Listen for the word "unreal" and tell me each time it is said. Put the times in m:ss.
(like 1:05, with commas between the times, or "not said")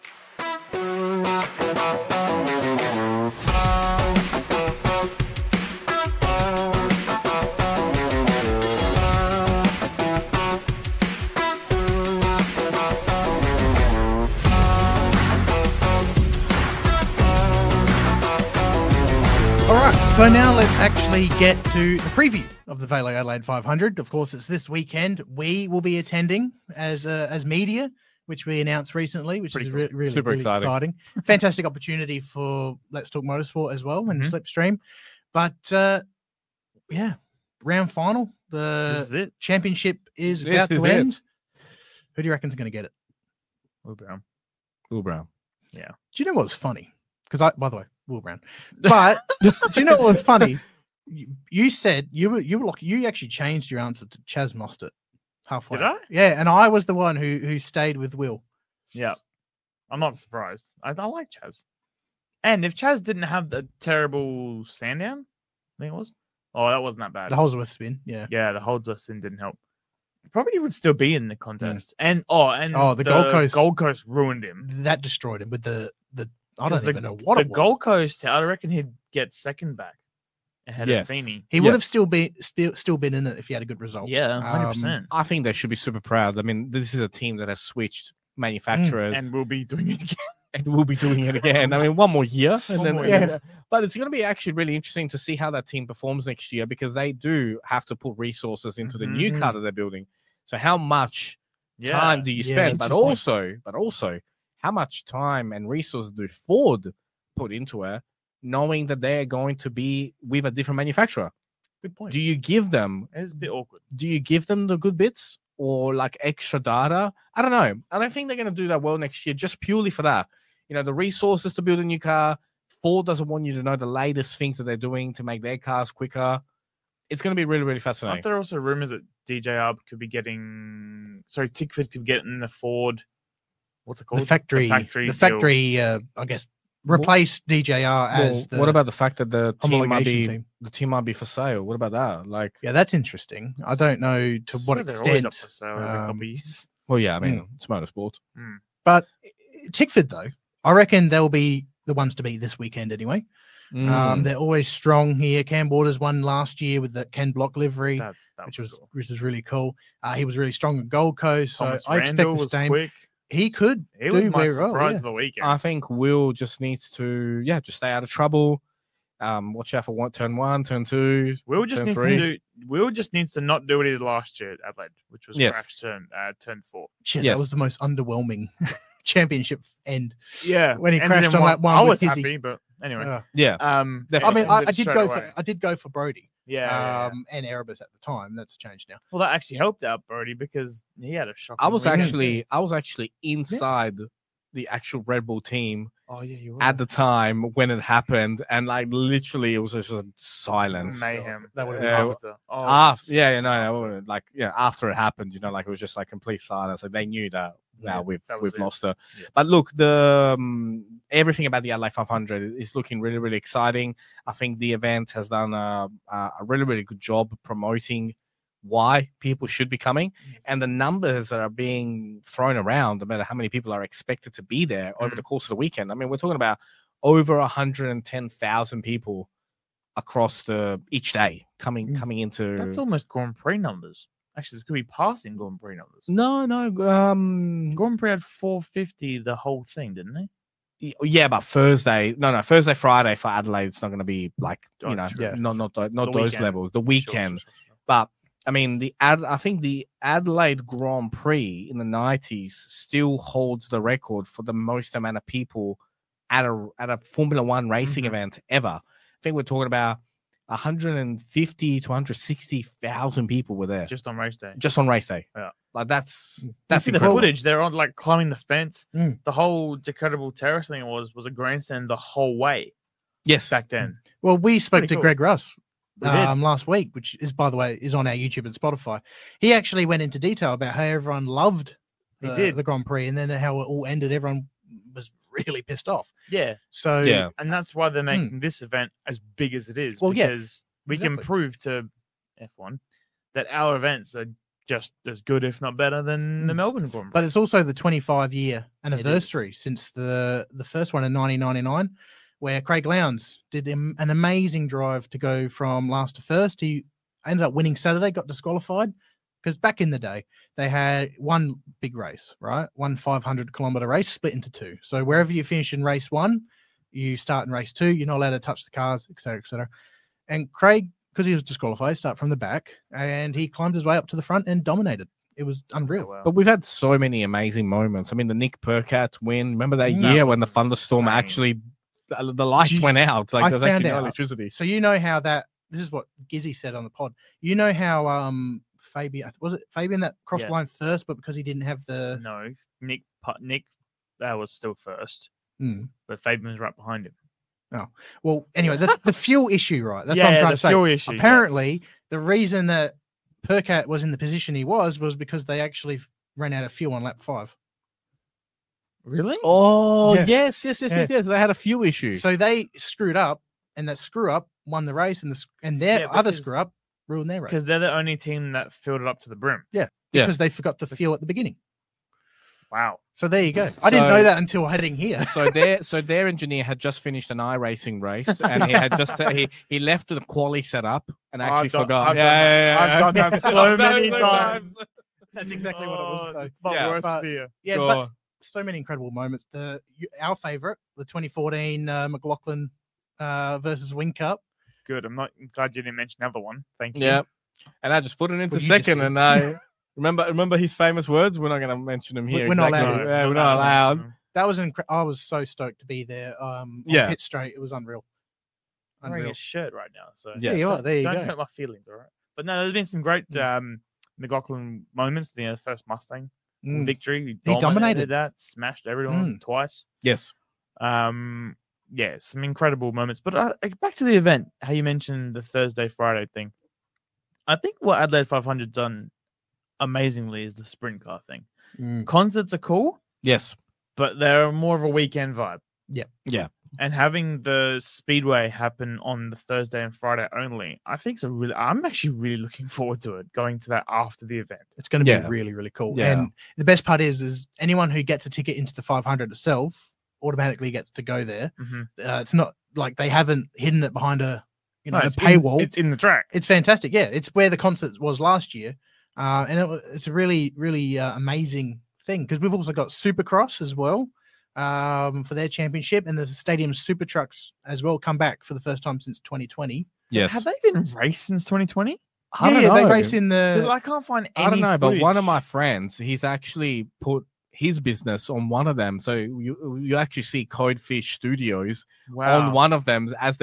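5:25, 6:47.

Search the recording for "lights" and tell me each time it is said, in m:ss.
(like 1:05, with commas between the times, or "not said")
5:32.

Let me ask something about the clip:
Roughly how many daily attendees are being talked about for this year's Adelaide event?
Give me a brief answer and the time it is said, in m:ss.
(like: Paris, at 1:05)
110,000, at 3:47.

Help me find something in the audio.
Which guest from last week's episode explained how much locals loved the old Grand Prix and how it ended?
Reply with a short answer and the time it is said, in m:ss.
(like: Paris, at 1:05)
Greg Rust, at 4:35.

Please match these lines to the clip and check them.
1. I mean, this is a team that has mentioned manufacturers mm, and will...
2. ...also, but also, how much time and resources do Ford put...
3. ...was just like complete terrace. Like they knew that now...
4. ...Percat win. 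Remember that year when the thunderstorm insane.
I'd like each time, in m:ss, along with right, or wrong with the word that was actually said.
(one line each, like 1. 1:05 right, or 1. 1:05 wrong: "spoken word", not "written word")
1. 1:26 wrong: "switched", not "mentioned"
2. 1:42 right
3. 3:25 wrong: "silence", not "terrace"
4. 5:28 right.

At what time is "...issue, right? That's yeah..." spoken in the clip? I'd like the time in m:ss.
5:49.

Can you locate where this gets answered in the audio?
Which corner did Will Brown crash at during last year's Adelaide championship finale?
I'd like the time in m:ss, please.
2:56.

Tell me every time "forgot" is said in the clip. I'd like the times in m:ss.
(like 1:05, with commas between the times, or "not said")
6:10, 6:21.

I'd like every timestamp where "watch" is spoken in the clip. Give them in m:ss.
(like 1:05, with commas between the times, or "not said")
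2:49.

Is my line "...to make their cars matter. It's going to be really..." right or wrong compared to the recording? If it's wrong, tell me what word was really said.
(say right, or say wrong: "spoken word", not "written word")
wrong: "quicker", not "matter".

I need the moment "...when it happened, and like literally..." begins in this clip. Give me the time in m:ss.
3:17.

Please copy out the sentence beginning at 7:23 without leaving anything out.
Going to that after the event, it's going to be really, really cool.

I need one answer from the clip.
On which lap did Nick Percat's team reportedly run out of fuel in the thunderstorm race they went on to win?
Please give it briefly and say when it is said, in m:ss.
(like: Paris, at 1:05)
Lap 5, at 5:57.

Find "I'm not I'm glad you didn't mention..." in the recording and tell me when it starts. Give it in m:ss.
6:35.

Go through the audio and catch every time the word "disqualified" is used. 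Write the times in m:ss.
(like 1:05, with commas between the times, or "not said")
5:08, 5:21.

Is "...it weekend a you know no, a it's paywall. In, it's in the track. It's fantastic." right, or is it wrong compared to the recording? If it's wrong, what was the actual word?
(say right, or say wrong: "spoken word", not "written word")
wrong: "behind", not "weekend".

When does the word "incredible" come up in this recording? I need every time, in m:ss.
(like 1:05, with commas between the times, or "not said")
6:28, 6:44, 7:02.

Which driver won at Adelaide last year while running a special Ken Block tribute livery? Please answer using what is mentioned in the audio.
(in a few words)
Cam Waters.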